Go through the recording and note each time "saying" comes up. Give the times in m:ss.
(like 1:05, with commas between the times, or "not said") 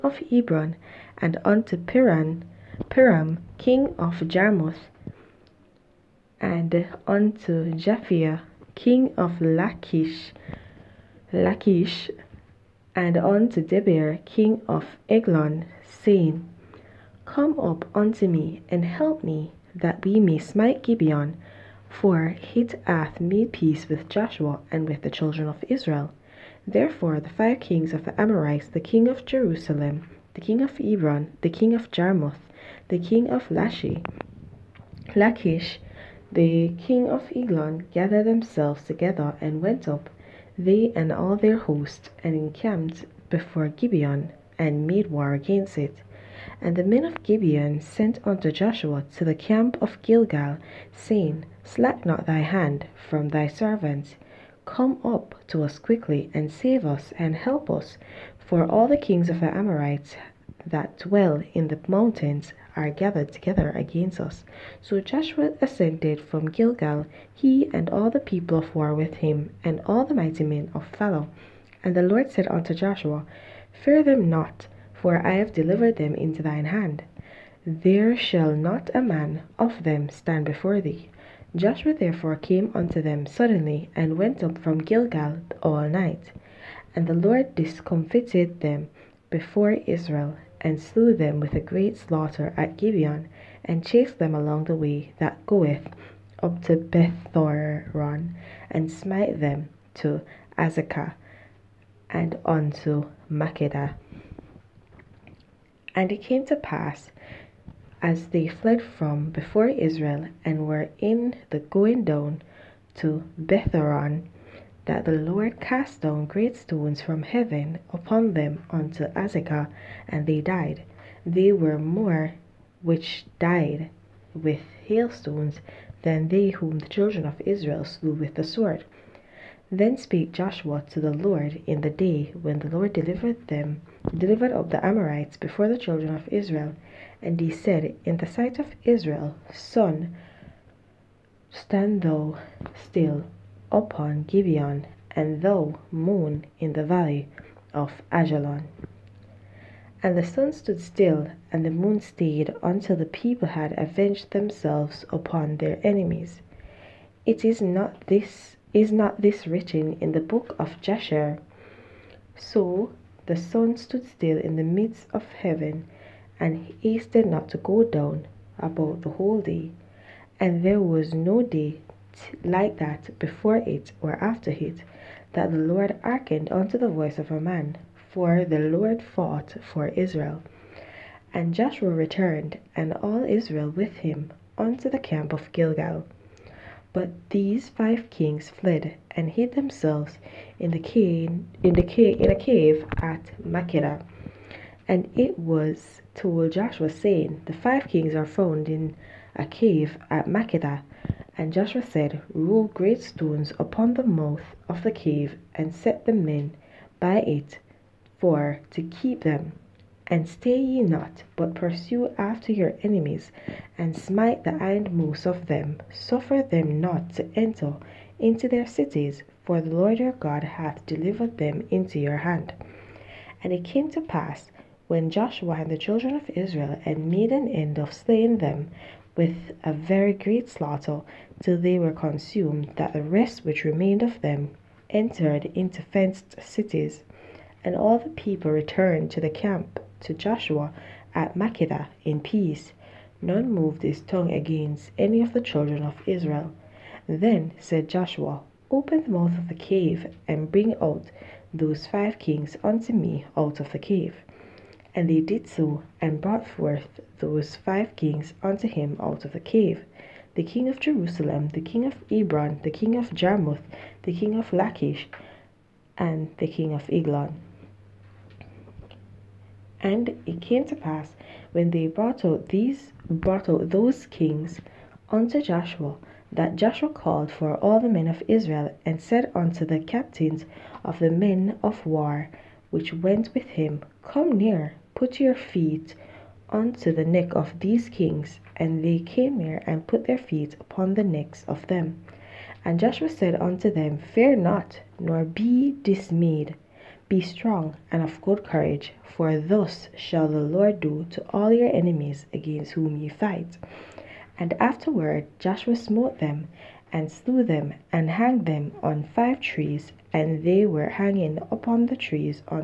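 0:15, 0:50, 3:16.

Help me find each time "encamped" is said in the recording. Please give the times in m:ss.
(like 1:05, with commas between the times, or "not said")
0:42.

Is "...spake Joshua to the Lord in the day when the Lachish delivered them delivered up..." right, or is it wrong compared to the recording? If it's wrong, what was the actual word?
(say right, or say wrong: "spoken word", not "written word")
wrong: "Lord", not "Lachish".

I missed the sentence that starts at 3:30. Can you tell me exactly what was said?
And stay ye not, but pursue after your enemies, and smite the hindmost of them.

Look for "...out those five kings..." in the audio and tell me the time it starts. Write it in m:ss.
4:10.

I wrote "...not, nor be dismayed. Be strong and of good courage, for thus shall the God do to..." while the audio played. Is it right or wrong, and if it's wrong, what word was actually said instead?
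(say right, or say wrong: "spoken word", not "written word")
wrong: "Lord", not "God".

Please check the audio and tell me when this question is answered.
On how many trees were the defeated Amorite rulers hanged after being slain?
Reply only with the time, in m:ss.
5:09.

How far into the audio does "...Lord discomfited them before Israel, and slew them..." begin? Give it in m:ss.
1:27.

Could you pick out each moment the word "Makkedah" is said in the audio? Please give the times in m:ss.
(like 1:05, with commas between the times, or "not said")
1:43, 3:13, 3:20, 4:01.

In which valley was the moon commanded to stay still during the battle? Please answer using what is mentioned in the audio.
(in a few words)
Ajalon.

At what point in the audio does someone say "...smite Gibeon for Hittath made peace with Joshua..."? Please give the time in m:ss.
0:20.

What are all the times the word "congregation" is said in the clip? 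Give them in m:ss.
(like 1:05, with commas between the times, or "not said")
not said.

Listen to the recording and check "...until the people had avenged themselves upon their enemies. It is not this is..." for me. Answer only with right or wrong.
right.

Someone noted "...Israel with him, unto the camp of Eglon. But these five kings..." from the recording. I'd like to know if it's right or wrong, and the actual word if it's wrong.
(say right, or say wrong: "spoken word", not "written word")
wrong: "Gilgal", not "Eglon".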